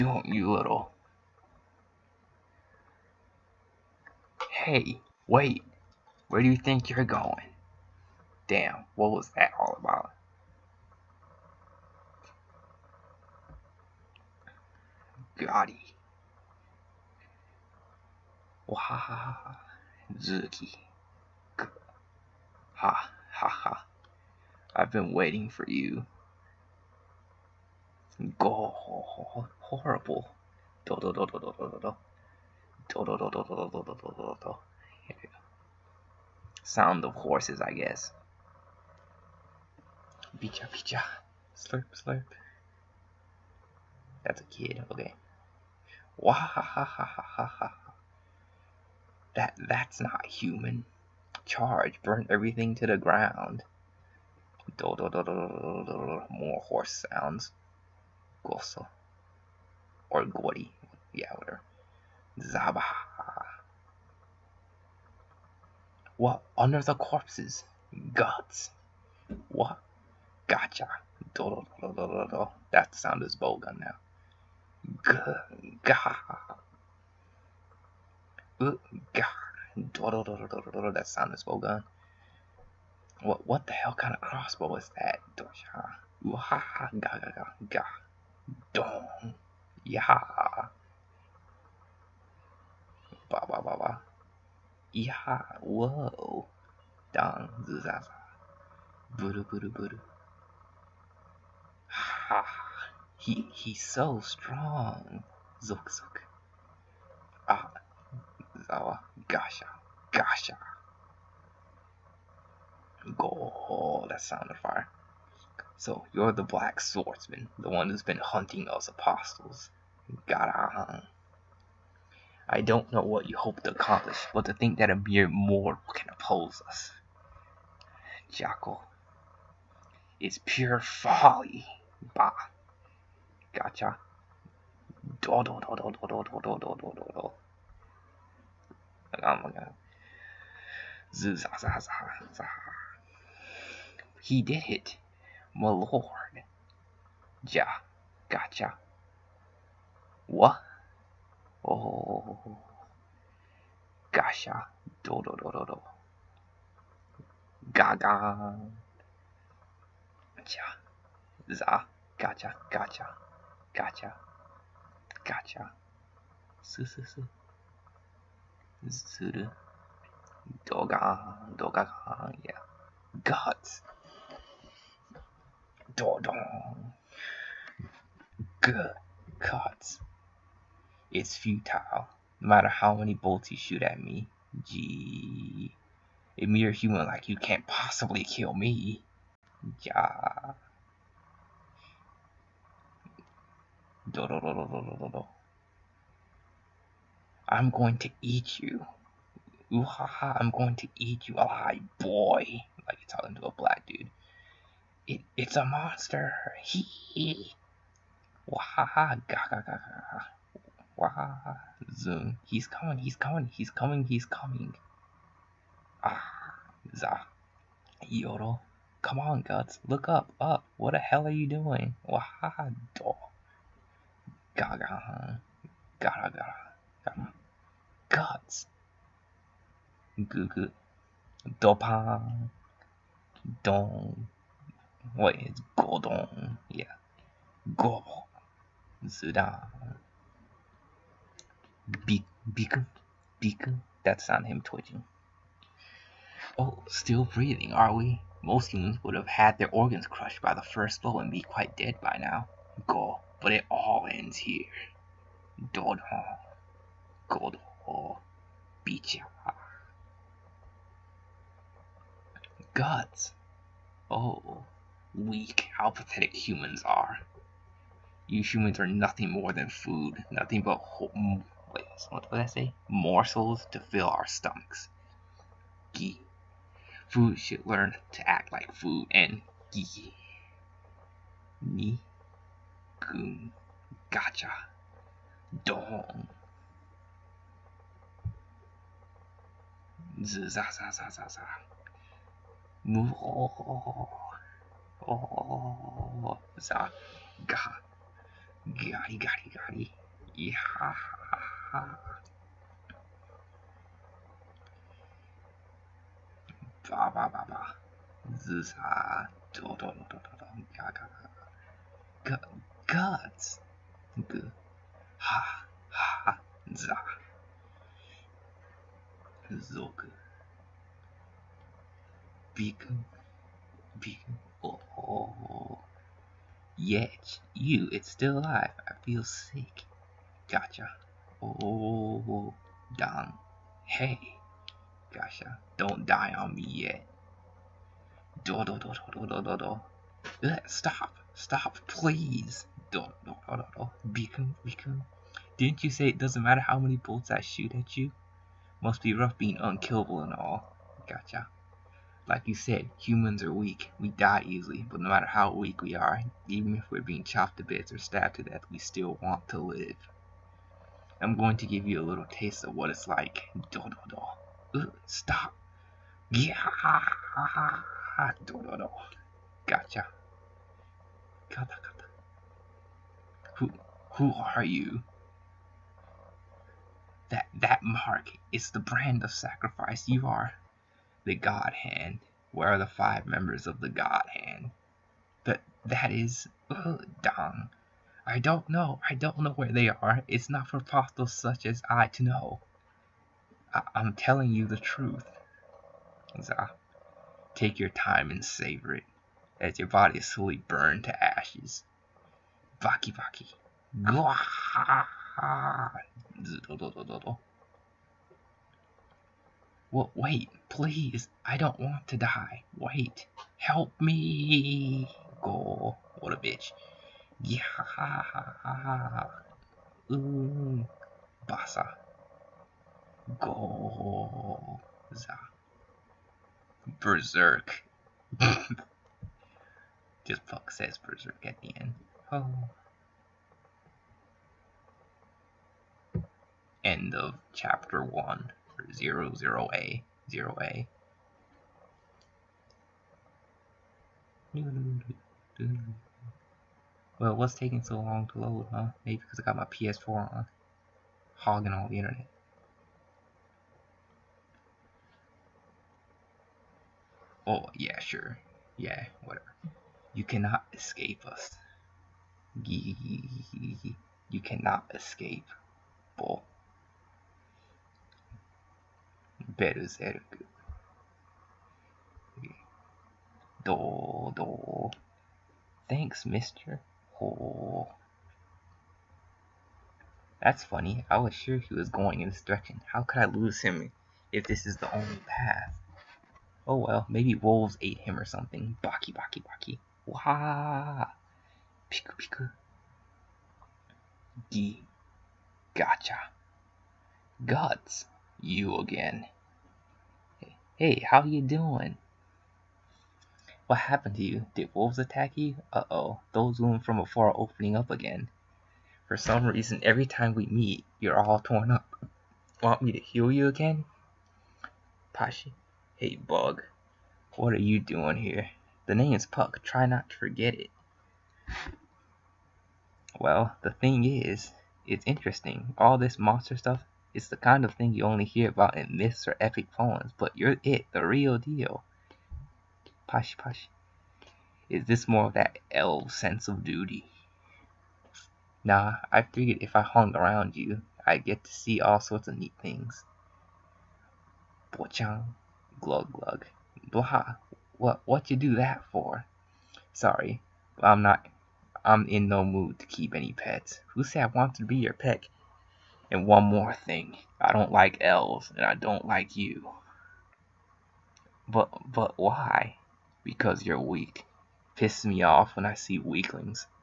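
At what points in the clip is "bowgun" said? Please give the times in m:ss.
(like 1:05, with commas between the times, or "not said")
1:13, 1:21.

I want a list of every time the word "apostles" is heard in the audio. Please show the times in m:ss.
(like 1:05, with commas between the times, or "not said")
1:58, 6:30.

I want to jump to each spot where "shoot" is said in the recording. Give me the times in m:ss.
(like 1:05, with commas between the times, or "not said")
3:03, 5:47.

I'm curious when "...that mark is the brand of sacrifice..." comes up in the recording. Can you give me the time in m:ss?
6:17.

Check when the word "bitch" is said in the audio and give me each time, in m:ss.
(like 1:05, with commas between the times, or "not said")
6:56.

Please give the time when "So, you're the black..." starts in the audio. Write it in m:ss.
1:55.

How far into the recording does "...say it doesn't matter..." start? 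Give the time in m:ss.
5:45.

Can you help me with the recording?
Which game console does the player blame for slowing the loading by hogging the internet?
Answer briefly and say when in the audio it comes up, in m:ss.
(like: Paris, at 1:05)
PS4, at 7:29.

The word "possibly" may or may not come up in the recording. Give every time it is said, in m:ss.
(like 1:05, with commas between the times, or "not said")
3:07.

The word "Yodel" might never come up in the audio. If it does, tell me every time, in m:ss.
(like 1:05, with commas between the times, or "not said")
3:38.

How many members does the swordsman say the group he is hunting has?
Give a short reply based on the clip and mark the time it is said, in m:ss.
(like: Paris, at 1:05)
5, at 6:22.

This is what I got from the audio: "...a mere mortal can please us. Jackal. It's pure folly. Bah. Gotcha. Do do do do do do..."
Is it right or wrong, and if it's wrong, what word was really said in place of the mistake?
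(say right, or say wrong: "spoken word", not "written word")
wrong: "oppose", not "please".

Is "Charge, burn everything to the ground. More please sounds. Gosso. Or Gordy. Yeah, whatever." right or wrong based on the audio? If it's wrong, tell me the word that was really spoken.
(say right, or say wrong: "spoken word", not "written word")
wrong: "horse", not "please".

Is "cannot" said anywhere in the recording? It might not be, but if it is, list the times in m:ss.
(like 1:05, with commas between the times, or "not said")
7:40, 7:44.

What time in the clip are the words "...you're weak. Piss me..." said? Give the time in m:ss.
9:23.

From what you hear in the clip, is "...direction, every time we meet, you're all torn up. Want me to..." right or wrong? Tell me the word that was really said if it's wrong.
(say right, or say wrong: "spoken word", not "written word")
wrong: "reason", not "direction".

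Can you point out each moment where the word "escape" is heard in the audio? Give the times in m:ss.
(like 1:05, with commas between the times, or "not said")
7:40, 7:44.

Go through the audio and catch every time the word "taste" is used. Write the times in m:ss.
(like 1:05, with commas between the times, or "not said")
6:02.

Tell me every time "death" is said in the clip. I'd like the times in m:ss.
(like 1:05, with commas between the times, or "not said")
5:58.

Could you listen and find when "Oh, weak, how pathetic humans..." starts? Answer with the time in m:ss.
4:24.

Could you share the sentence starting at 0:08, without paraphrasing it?
Damn, what was that all about?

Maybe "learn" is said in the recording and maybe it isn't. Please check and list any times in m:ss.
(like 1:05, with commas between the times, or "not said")
4:37.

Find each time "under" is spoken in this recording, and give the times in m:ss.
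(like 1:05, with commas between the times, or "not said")
1:06.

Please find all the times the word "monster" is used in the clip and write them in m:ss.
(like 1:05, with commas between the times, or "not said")
3:25, 8:46.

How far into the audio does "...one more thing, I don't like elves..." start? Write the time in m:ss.
9:16.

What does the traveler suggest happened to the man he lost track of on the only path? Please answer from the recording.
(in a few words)
wolves ate him.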